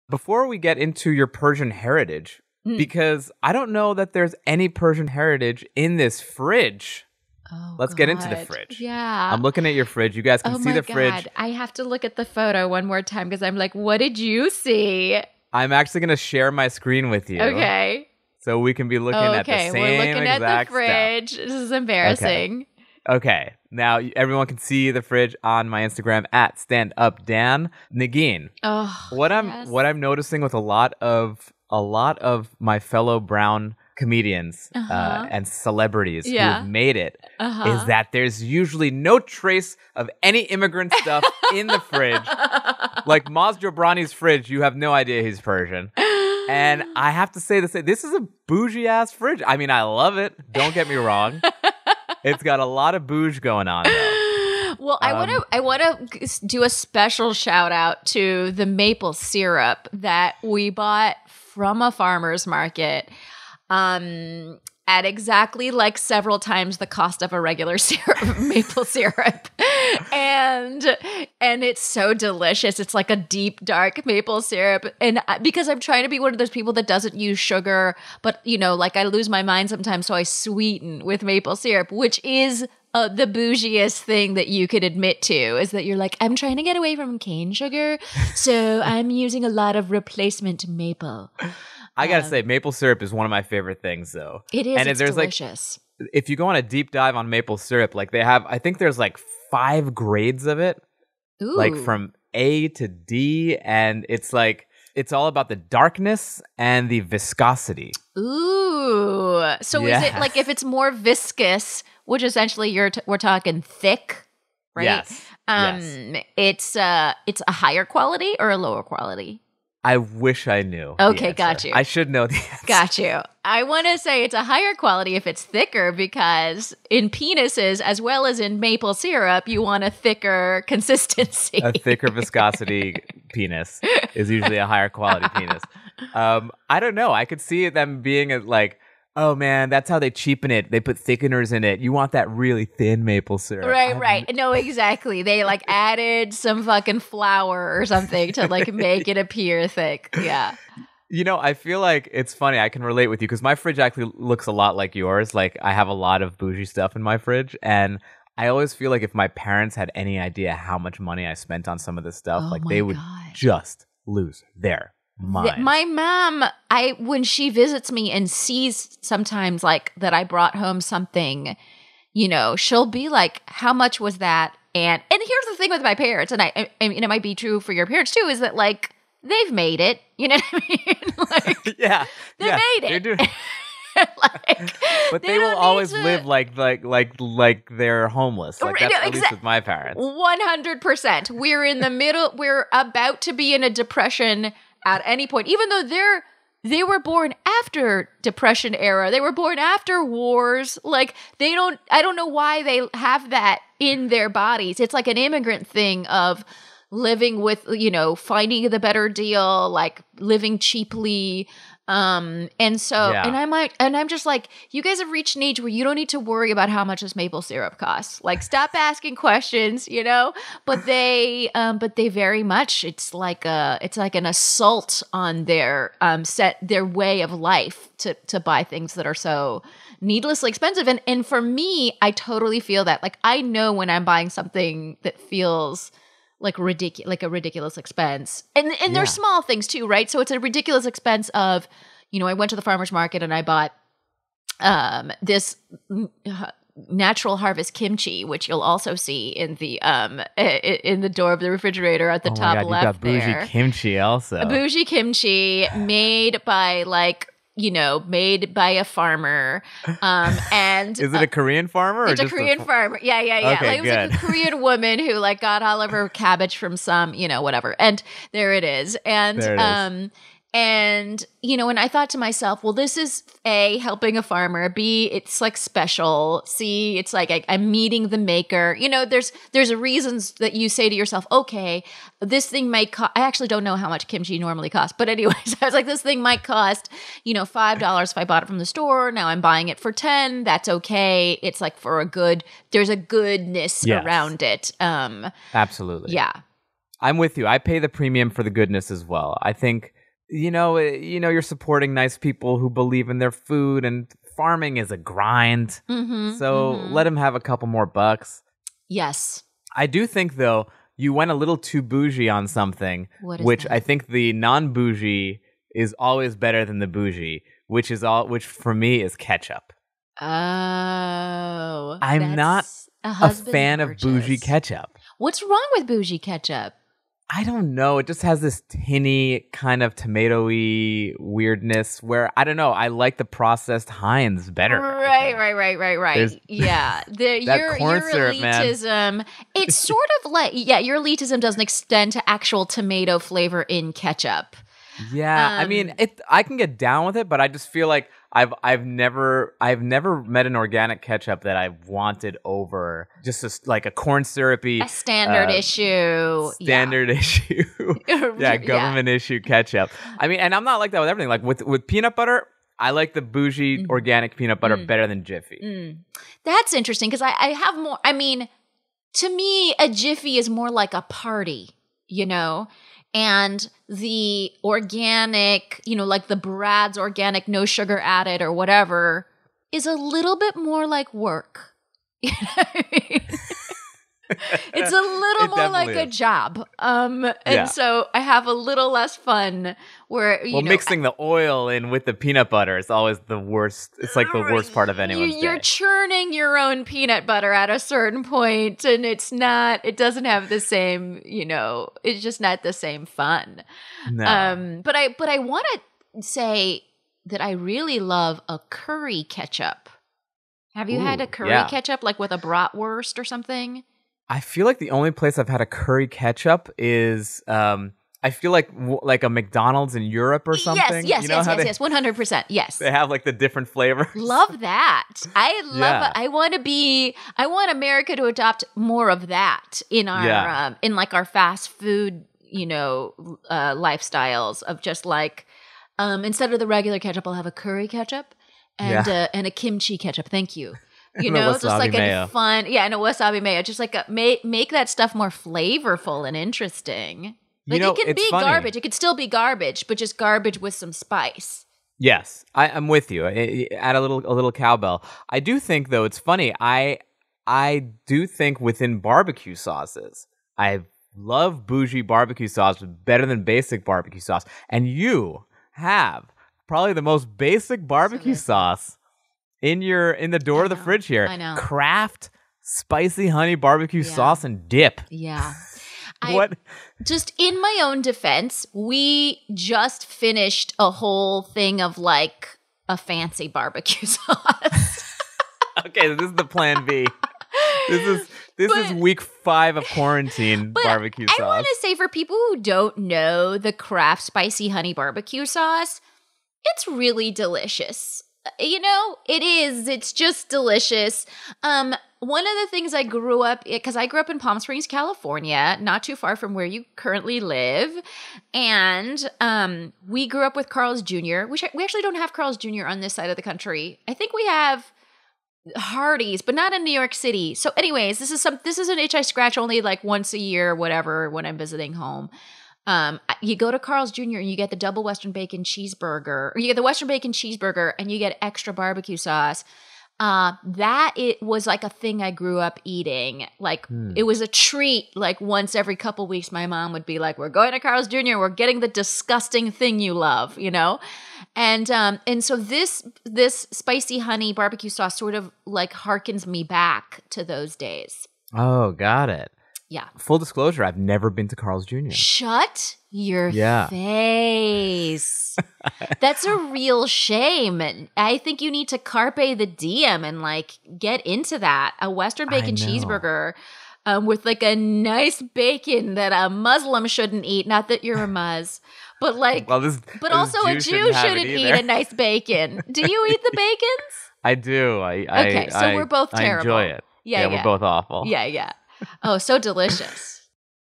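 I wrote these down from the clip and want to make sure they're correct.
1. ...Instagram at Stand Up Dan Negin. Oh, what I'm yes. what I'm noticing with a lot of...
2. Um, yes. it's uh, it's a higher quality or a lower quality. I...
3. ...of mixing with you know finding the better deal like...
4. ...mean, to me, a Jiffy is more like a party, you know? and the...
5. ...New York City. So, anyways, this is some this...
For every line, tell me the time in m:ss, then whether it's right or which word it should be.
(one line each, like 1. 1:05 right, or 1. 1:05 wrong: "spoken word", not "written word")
1. 0:25 right
2. 1:55 right
3. 3:26 wrong: "living", not "mixing"
4. 6:08 right
5. 8:36 right.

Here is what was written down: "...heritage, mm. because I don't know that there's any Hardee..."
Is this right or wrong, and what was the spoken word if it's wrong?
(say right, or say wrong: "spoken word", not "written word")
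wrong: "Persian", not "Hardee".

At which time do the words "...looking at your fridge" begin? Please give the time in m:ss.
0:09.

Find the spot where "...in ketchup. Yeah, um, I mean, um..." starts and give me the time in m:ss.
5:43.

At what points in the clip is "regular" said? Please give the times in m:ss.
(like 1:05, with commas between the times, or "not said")
1:07, 7:16.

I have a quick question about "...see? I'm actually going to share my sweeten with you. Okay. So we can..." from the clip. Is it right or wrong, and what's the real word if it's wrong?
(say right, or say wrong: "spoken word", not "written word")
wrong: "screen", not "sweeten".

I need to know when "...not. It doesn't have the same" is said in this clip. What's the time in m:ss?
6:39.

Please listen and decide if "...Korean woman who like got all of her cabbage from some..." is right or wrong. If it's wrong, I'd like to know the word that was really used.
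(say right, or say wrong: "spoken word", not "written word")
right.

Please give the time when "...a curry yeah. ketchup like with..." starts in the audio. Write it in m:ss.
6:51.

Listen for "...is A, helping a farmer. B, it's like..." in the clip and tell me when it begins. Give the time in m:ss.
4:32.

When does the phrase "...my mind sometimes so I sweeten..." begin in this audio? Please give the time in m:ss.
1:19.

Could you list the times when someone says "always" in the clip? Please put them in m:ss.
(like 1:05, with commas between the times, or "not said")
2:38, 3:05, 5:15, 6:32.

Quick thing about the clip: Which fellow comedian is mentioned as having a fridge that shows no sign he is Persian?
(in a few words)
Maz Jobrani.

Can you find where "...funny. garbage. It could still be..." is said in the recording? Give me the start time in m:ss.
7:28.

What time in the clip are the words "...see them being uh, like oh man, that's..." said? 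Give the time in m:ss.
2:17.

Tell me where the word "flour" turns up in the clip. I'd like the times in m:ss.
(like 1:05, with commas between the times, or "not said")
2:26.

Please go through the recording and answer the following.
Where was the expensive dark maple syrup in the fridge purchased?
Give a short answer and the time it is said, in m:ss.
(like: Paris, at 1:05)
a farmer's market, at 1:01.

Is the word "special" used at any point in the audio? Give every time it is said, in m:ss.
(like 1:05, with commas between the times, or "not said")
0:56, 4:35.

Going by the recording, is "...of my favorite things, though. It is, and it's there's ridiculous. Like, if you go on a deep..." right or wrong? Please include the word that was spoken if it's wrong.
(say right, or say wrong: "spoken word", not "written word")
wrong: "delicious", not "ridiculous".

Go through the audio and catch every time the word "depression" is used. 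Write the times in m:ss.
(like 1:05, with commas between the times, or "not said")
3:13, 3:18.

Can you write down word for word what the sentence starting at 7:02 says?
Yes, they have like the different flavors.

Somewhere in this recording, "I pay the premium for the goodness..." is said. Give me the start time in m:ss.
4:57.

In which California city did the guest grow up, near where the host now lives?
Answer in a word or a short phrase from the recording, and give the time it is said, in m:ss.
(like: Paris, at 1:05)
Palm Springs, at 8:24.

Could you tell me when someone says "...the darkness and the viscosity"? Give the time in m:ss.
1:45.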